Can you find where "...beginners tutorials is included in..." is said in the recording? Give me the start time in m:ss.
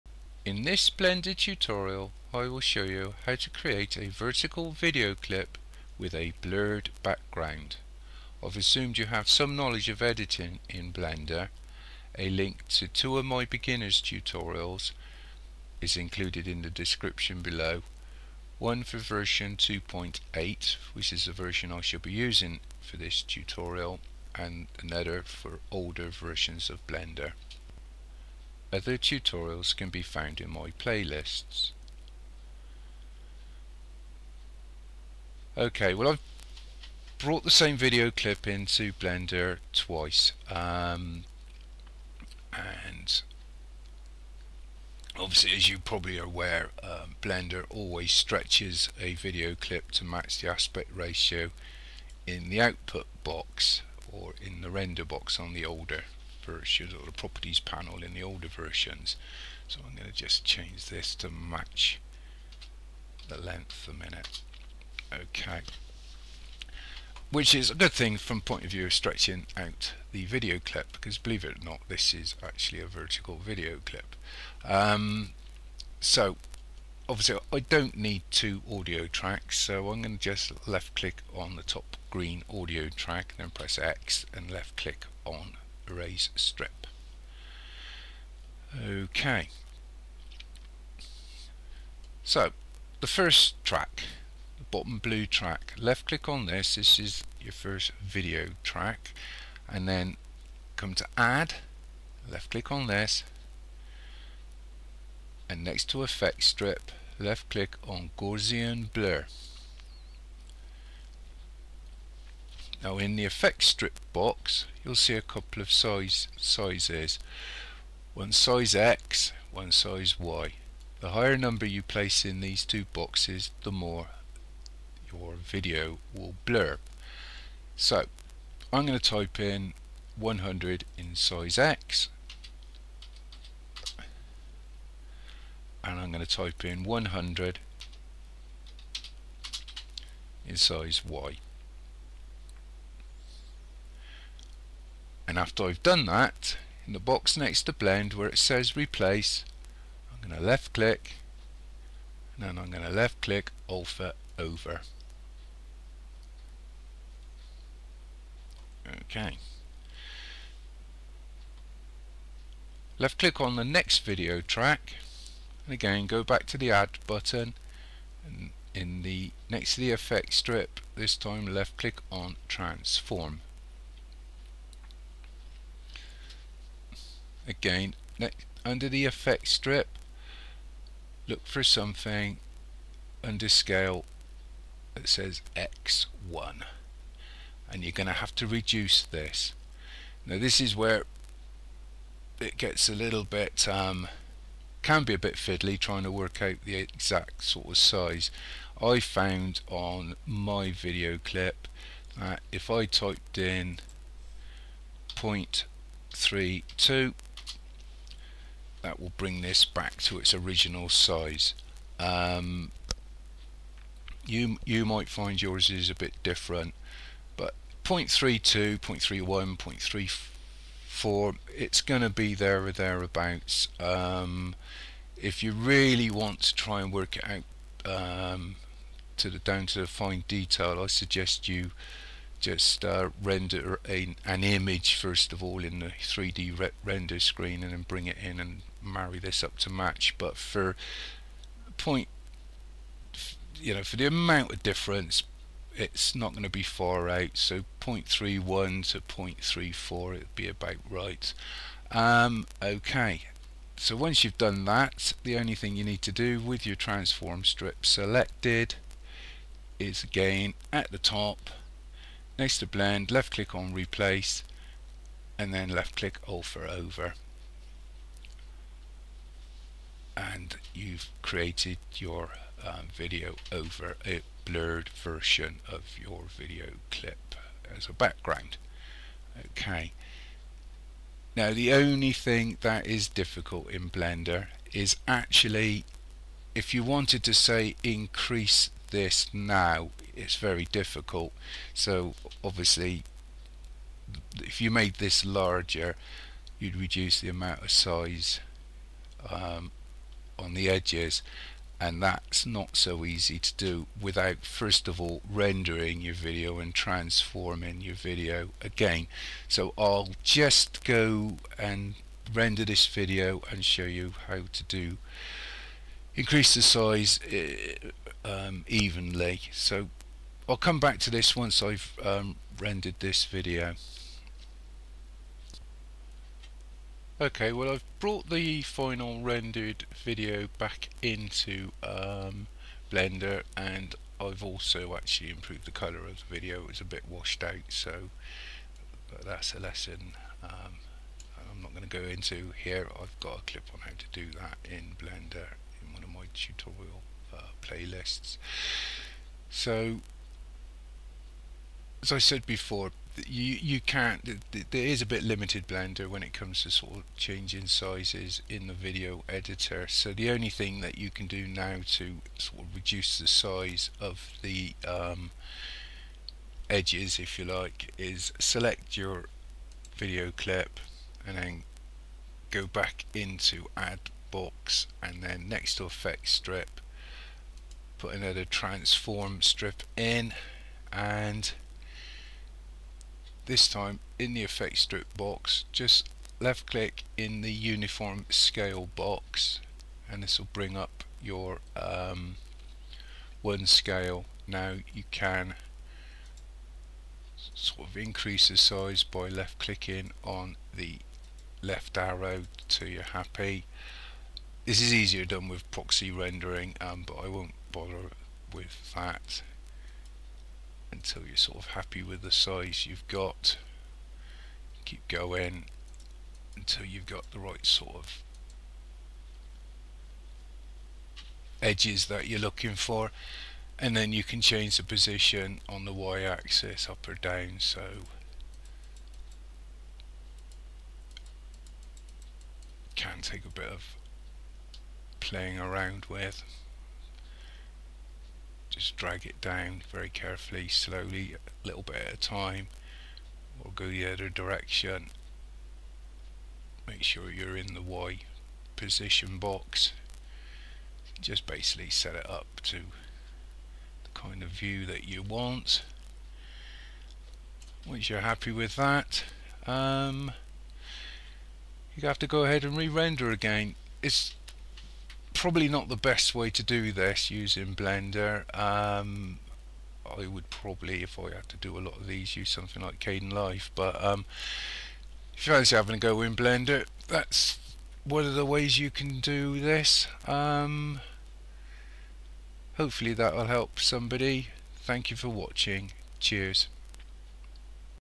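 0:13.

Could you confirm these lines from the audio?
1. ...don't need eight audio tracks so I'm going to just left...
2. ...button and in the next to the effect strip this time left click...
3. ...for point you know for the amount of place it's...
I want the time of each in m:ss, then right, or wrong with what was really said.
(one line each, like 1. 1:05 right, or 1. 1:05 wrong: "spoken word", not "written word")
1. 1:17 wrong: "two", not "eight"
2. 2:47 right
3. 4:00 wrong: "difference", not "place".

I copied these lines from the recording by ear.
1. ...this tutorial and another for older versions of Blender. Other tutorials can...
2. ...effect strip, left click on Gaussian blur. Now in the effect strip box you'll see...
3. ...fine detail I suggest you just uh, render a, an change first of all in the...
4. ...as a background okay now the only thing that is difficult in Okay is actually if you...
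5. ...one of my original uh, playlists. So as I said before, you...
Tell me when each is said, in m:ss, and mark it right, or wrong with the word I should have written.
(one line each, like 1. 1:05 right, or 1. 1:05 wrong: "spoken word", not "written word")
1. 0:22 right
2. 1:46 right
3. 3:49 wrong: "image", not "change"
4. 4:37 wrong: "Blender", not "Okay"
5. 5:45 wrong: "tutorial", not "original".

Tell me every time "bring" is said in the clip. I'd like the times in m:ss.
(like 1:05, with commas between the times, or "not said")
3:29, 3:57, 6:30.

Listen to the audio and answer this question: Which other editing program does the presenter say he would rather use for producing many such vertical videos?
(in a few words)
Kdenlive.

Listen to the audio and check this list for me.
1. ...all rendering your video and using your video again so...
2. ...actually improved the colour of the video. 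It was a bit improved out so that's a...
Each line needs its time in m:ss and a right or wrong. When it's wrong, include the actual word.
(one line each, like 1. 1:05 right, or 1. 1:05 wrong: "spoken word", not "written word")
1. 5:04 wrong: "transforming", not "using"
2. 5:34 wrong: "washed", not "improved".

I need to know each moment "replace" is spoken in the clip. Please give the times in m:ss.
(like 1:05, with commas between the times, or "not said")
2:28, 4:23.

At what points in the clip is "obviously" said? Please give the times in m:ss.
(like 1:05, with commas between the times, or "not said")
0:45, 1:17, 4:52.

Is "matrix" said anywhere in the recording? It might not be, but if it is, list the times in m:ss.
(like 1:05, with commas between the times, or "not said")
not said.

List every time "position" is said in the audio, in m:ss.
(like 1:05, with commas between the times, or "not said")
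7:04, 7:28.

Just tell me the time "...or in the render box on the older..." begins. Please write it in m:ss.
0:54.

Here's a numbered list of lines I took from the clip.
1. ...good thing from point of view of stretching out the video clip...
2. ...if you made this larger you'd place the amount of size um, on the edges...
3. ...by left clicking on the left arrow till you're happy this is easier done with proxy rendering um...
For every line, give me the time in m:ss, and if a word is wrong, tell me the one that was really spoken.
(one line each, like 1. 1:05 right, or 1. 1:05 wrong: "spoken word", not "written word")
1. 1:07 right
2. 4:54 wrong: "reduce", not "place"
3. 6:39 right.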